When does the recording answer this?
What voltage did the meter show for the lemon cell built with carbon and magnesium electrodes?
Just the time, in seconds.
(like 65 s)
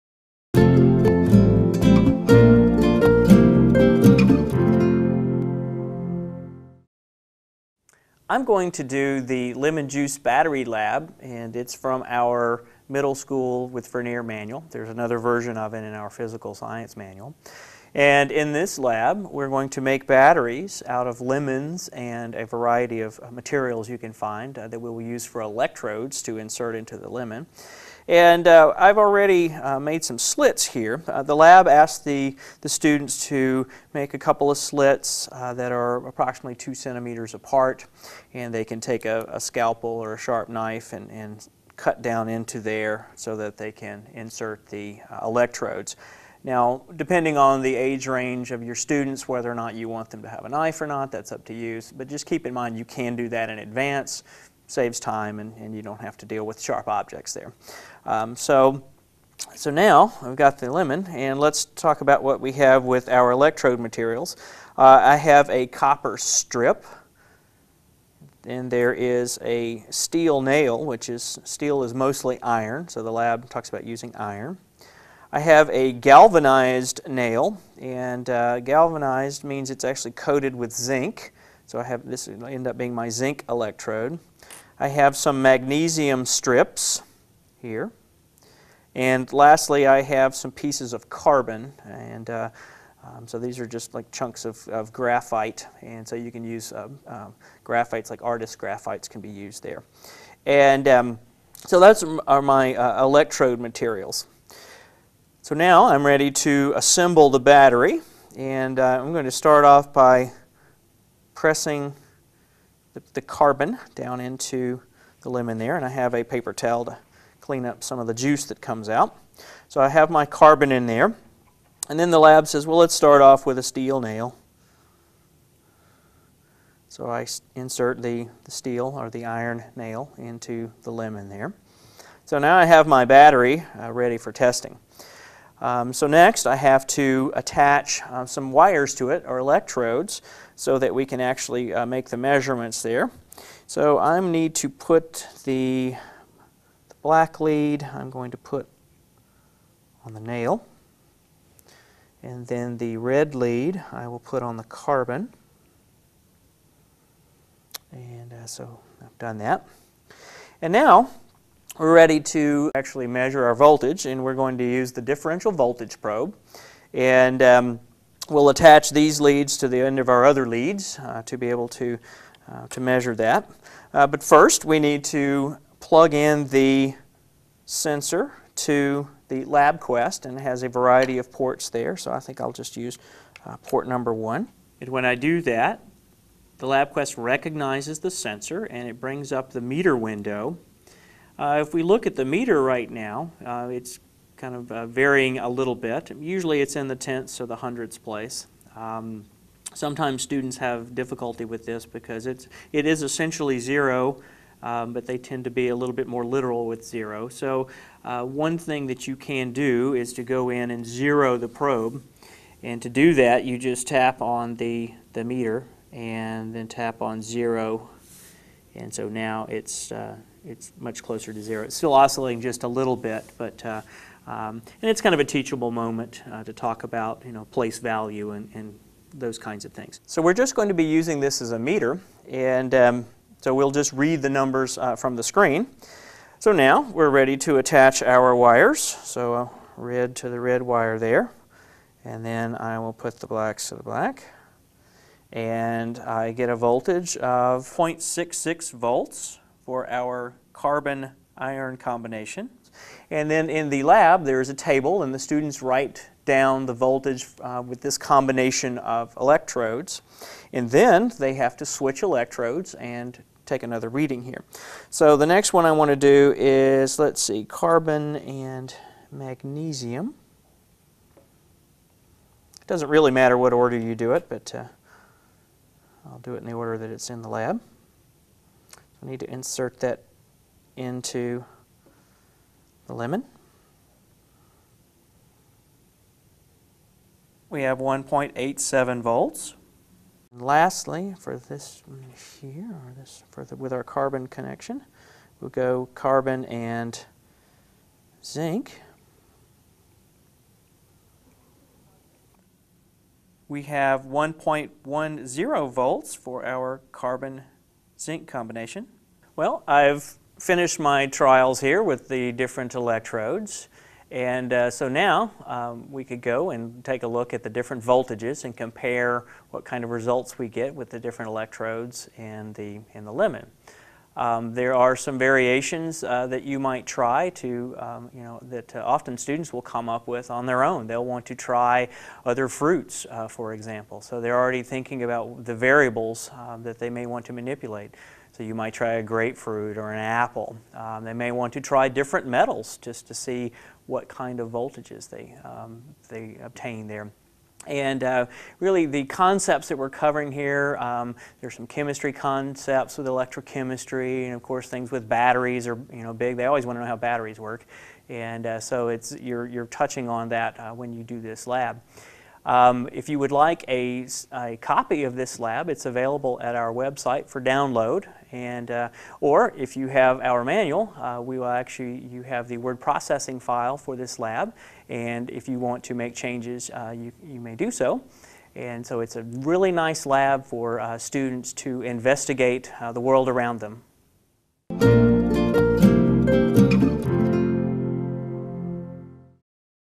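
287 s.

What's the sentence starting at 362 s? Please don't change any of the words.
Um, if you would like a, a, copy of this lab, it's available at our website for download.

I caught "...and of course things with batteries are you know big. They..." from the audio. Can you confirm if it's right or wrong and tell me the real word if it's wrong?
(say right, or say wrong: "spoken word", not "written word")
right.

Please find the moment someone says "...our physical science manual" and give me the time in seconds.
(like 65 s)
15 s.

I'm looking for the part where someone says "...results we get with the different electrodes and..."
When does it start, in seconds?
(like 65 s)
319 s.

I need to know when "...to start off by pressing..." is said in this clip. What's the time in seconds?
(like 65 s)
109 s.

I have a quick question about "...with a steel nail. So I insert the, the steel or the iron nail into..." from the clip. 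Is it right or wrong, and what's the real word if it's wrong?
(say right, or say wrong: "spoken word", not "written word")
right.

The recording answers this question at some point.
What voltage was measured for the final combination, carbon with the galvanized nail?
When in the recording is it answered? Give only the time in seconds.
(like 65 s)
304 s.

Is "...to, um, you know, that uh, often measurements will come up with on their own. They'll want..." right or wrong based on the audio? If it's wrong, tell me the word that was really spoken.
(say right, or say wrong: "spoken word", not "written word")
wrong: "students", not "measurements".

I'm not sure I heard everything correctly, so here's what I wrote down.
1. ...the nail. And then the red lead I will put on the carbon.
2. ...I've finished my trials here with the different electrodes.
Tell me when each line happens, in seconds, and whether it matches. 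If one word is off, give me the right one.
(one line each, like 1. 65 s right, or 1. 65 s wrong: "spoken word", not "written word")
1. 150 s right
2. 309 s right.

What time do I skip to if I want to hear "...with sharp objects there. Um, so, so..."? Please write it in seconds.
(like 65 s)
56 s.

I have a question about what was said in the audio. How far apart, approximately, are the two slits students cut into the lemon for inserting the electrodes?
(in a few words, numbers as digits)
2 centimeters.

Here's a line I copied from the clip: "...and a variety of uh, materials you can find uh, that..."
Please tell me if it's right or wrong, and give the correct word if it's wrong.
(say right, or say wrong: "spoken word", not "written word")
right.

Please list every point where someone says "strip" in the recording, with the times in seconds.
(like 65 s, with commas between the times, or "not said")
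66 s, 86 s.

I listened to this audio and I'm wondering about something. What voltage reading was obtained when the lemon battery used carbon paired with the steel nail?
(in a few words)
0.66 volts.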